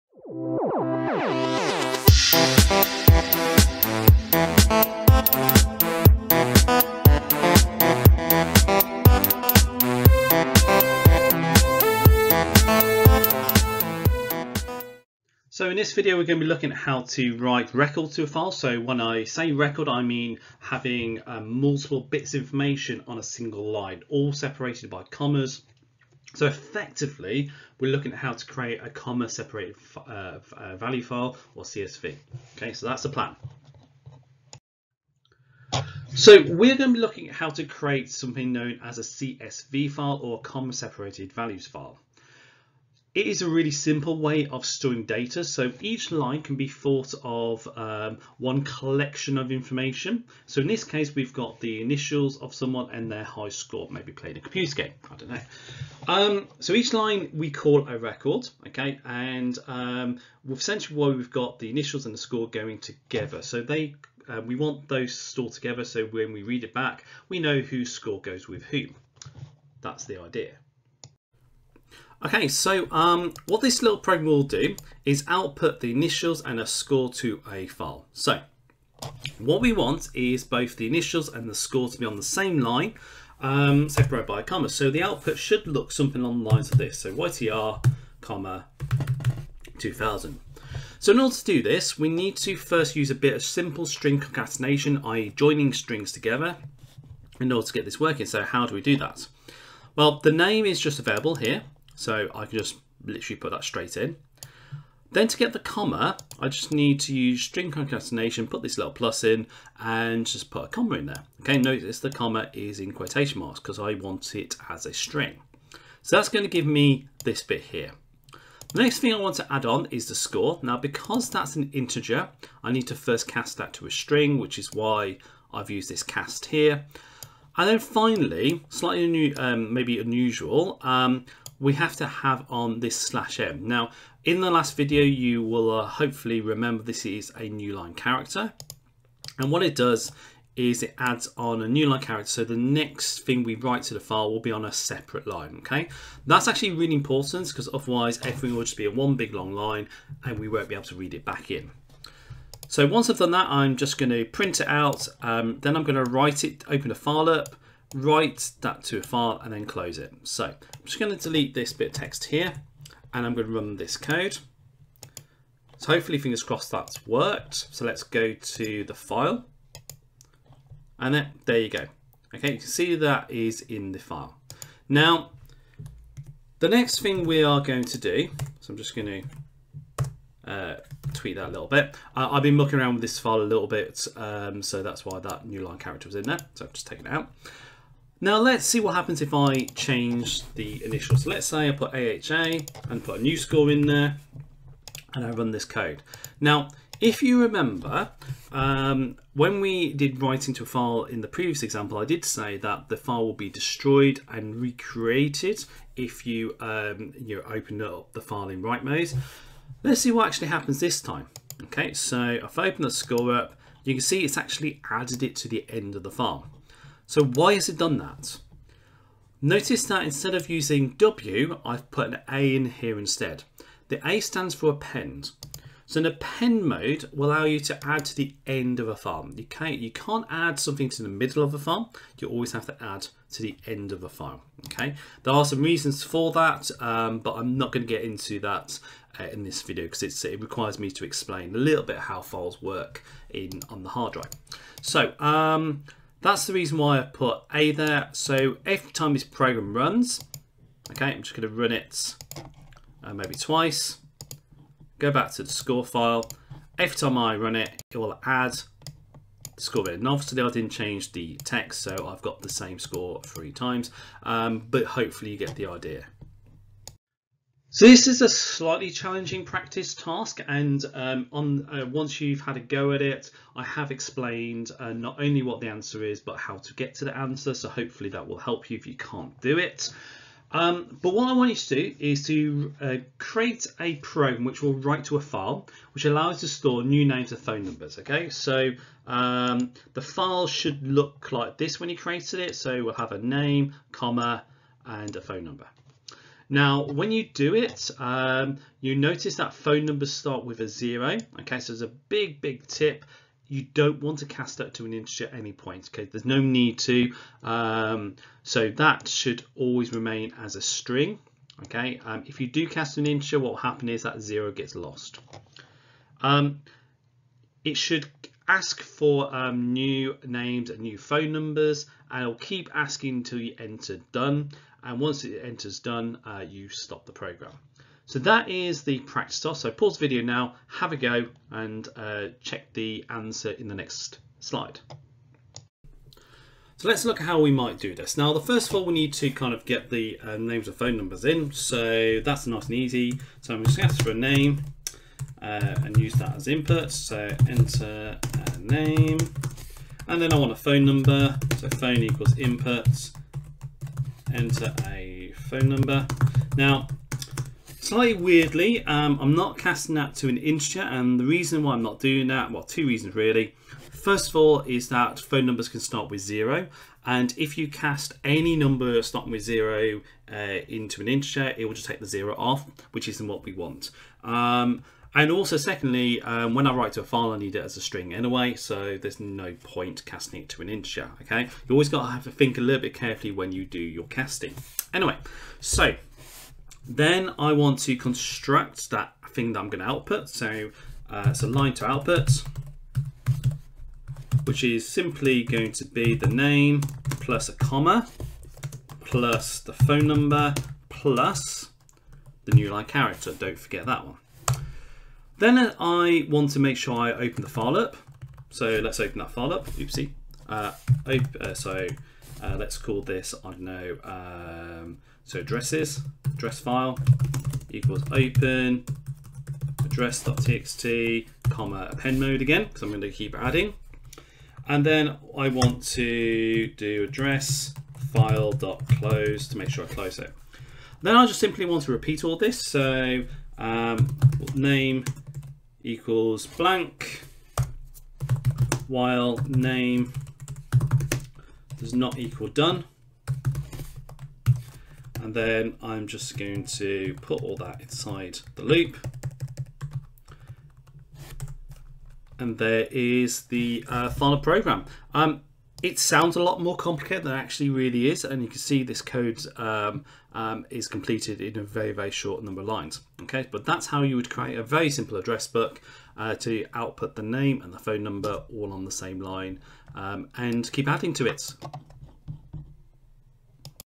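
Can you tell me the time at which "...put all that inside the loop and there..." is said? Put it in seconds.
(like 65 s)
447 s.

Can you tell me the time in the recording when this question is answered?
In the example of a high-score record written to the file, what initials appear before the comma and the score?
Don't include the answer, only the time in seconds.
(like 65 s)
87 s.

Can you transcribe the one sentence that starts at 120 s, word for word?
Now, because that's an integer, I need to first cast that to a string, which is why I've used this cast here.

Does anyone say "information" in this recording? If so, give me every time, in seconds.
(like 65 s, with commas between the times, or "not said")
22 s, 49 s.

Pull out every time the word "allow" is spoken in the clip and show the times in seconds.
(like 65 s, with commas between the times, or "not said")
227 s, 286 s.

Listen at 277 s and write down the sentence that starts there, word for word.
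So hopefully that will help you if you can't do it.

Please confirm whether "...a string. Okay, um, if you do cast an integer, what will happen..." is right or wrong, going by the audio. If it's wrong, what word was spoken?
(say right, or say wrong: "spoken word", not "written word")
right.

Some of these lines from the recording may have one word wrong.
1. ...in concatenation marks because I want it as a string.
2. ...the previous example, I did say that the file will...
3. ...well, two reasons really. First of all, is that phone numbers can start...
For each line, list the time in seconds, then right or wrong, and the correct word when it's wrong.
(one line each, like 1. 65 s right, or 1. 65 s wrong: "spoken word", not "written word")
1. 112 s wrong: "quotation", not "concatenation"
2. 201 s right
3. 362 s right.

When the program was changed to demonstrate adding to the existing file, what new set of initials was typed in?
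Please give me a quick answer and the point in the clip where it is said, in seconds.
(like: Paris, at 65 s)
AHA, at 191 s.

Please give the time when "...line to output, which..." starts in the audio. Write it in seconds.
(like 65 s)
391 s.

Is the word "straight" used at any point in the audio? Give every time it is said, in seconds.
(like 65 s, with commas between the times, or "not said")
103 s.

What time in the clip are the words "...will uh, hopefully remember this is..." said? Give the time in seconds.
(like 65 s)
135 s.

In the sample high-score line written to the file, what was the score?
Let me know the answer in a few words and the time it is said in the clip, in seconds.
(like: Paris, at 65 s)
2000, at 89 s.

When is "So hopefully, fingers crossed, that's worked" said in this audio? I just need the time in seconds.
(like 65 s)
165 s.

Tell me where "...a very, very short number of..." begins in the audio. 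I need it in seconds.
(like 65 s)
461 s.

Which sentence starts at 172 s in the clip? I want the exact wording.
Okay, you can see that is in the file.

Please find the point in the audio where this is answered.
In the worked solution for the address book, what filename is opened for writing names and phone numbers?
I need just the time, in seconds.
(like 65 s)
419 s.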